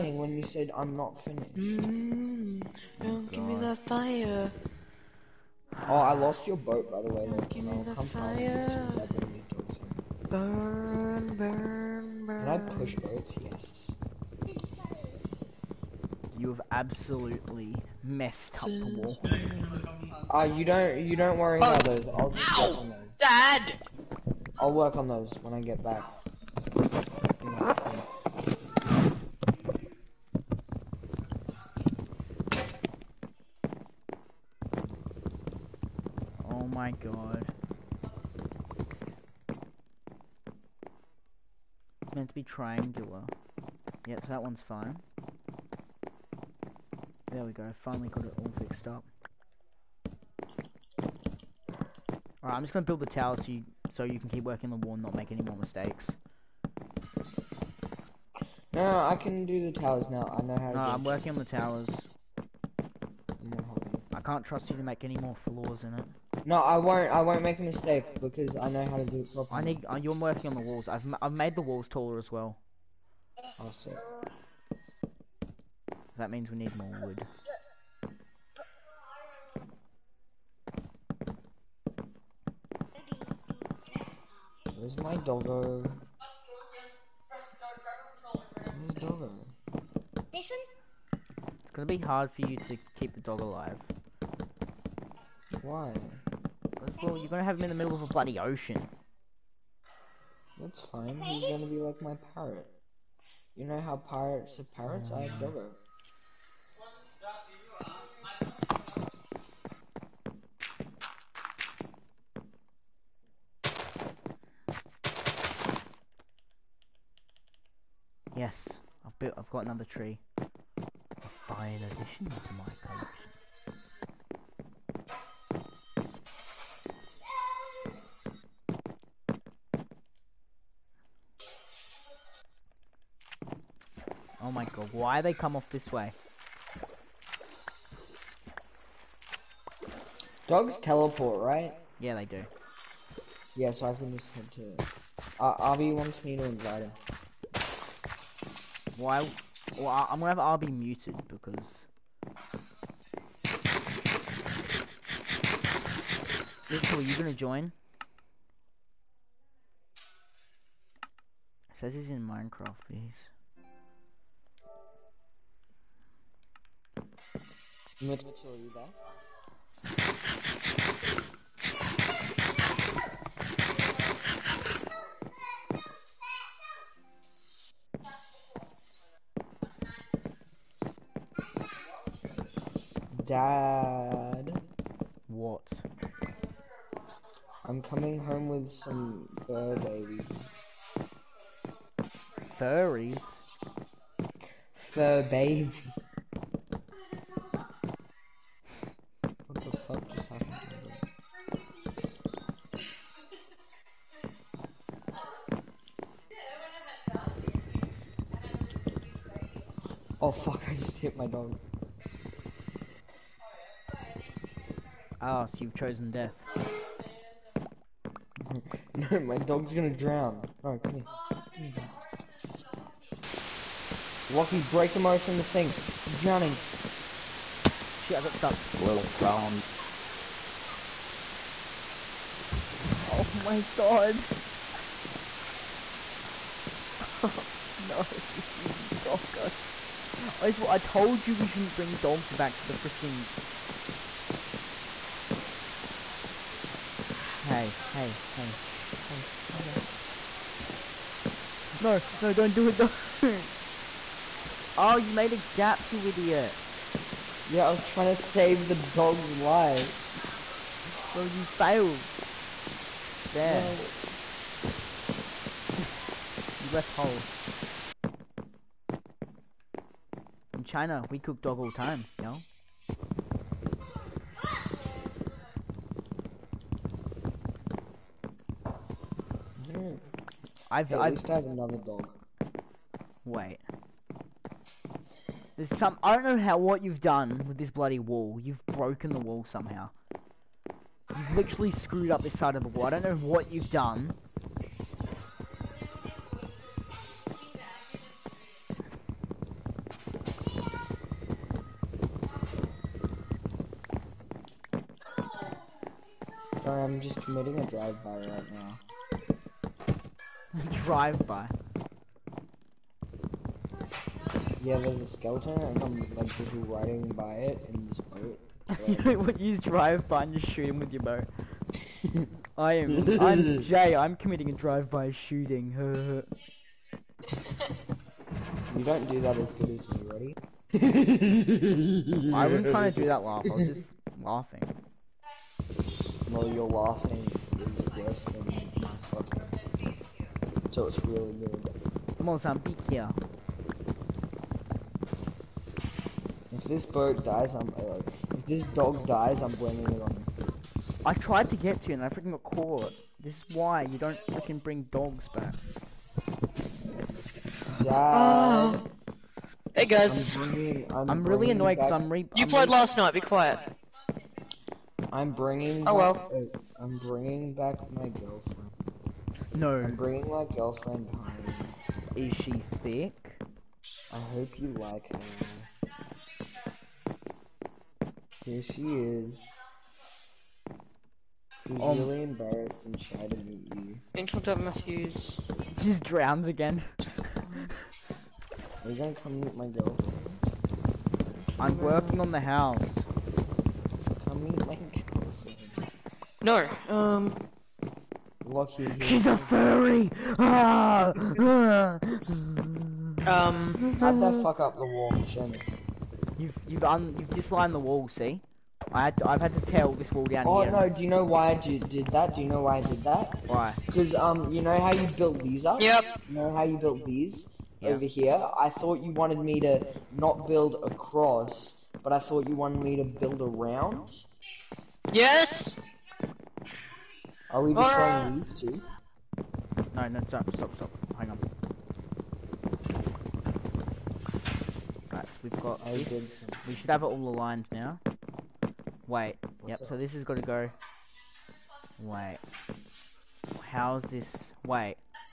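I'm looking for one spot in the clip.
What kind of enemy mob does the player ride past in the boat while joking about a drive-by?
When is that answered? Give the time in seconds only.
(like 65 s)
315 s.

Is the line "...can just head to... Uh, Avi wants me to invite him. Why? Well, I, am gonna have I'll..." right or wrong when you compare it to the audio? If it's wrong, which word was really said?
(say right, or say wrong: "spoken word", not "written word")
right.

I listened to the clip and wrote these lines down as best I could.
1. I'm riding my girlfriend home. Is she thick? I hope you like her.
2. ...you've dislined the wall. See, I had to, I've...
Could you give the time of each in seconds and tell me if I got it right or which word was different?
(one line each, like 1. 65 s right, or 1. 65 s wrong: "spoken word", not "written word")
1. 369 s wrong: "bringing", not "riding"
2. 407 s right.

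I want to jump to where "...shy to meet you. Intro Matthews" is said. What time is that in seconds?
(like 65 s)
383 s.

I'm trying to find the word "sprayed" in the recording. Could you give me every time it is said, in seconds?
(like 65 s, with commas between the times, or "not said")
not said.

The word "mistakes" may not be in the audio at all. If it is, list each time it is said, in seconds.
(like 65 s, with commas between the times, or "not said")
55 s, 67 s.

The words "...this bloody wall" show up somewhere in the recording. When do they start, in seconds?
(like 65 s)
287 s.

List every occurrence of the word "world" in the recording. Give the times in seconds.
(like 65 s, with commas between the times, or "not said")
not said.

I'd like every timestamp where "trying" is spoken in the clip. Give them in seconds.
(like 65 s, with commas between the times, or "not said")
257 s, 332 s.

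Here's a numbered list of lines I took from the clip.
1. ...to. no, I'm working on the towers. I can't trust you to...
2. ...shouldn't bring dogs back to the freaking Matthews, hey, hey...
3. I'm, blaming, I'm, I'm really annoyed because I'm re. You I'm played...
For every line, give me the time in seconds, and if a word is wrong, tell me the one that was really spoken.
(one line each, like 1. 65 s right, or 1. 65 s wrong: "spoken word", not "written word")
1. 60 s right
2. 241 s wrong: "Hey", not "Matthews"
3. 360 s wrong: "bringing", not "blaming".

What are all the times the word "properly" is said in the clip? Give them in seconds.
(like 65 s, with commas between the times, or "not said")
69 s.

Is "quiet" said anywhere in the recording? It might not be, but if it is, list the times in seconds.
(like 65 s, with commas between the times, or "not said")
363 s.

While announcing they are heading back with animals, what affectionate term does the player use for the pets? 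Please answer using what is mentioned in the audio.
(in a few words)
Fur babies.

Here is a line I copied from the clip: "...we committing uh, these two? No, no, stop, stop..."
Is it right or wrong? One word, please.
wrong.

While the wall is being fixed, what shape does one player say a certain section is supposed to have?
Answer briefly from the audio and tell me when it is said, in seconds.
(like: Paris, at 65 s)
Triangular, at 42 s.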